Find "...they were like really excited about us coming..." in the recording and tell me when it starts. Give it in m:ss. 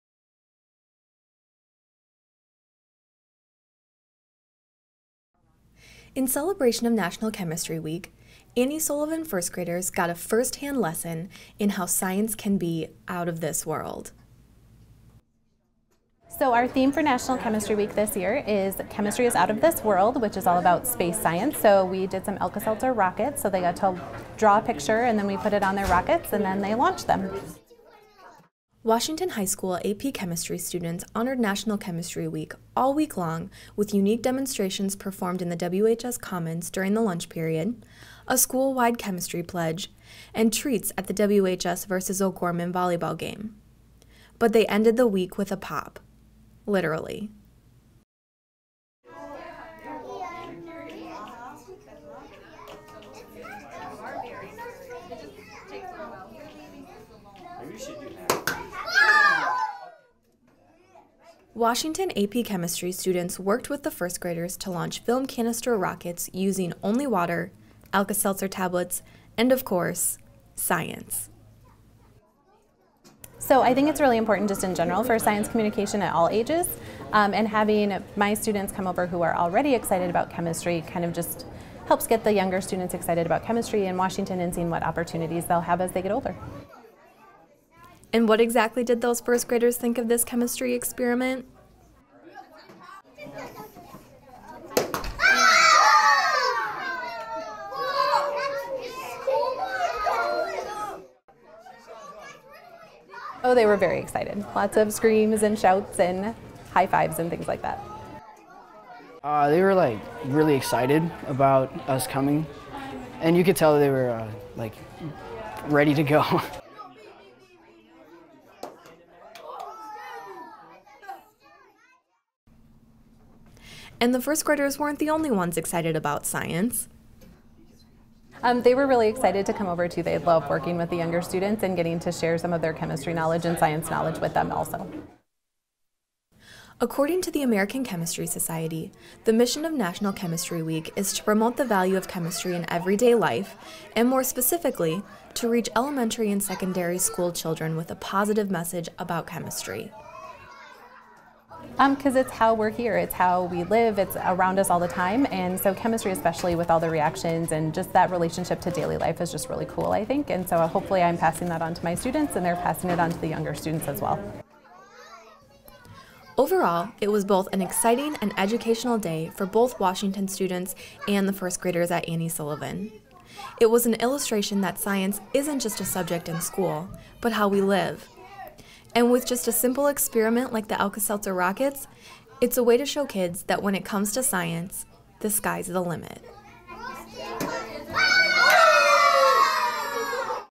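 1:49.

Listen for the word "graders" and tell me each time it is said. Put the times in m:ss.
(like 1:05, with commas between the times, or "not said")
0:09, 1:04, 1:29, 2:04, 2:51.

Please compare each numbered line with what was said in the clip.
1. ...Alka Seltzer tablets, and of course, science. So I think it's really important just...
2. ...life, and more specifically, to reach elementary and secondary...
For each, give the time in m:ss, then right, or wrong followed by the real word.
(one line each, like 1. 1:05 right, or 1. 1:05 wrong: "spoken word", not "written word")
1. 1:07 right
2. 2:23 right.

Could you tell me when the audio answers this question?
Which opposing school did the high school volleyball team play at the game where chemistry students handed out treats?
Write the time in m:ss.
0:42.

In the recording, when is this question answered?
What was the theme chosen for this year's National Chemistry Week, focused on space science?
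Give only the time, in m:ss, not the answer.
0:18.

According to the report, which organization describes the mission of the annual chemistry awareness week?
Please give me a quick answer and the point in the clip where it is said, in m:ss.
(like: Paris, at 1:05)
American Chemistry Society, at 2:17.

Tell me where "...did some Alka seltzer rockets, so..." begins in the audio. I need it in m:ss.
0:22.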